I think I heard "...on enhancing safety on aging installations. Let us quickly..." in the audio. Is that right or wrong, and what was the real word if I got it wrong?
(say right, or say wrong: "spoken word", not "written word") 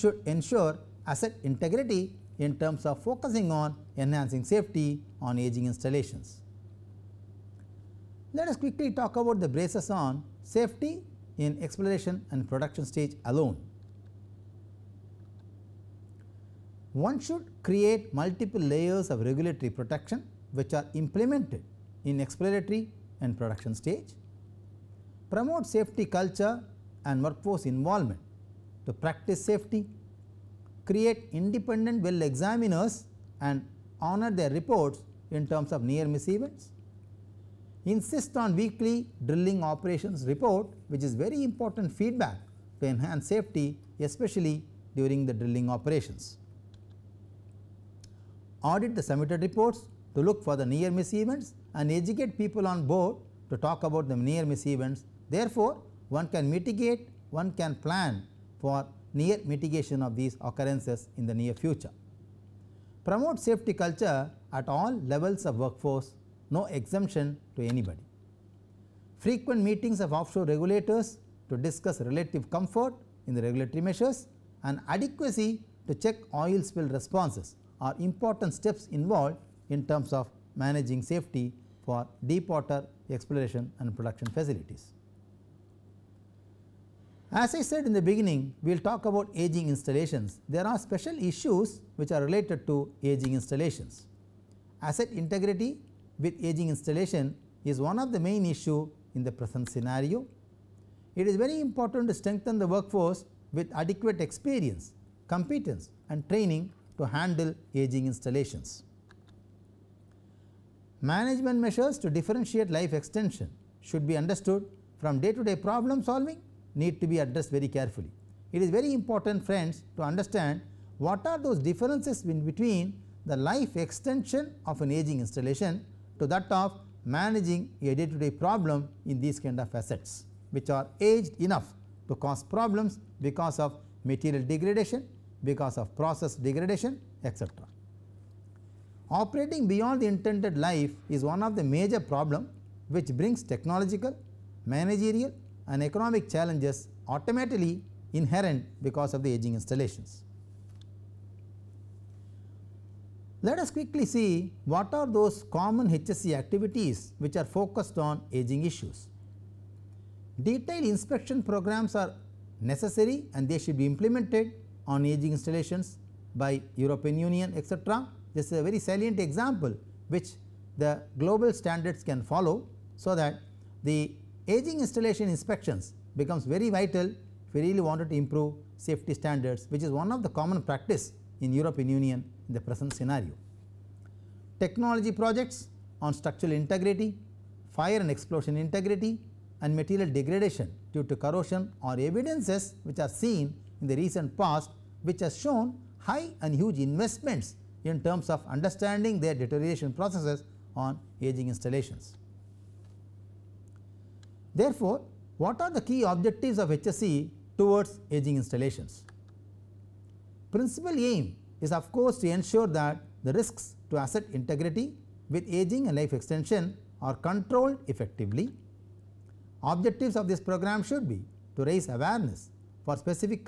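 right.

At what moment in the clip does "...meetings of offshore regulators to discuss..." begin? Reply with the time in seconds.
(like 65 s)
69 s.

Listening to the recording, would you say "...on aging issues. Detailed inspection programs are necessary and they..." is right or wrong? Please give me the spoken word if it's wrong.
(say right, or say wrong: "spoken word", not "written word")
right.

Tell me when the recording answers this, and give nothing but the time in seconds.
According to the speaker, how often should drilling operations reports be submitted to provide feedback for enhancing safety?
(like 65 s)
38 s.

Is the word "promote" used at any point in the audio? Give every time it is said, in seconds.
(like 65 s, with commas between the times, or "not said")
25 s, 63 s.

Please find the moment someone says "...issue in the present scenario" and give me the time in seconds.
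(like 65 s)
98 s.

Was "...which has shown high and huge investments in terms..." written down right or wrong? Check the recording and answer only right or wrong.
right.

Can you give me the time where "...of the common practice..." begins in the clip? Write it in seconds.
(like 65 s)
180 s.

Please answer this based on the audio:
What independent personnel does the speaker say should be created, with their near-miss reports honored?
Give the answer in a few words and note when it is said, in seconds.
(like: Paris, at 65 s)
Well examiners, at 32 s.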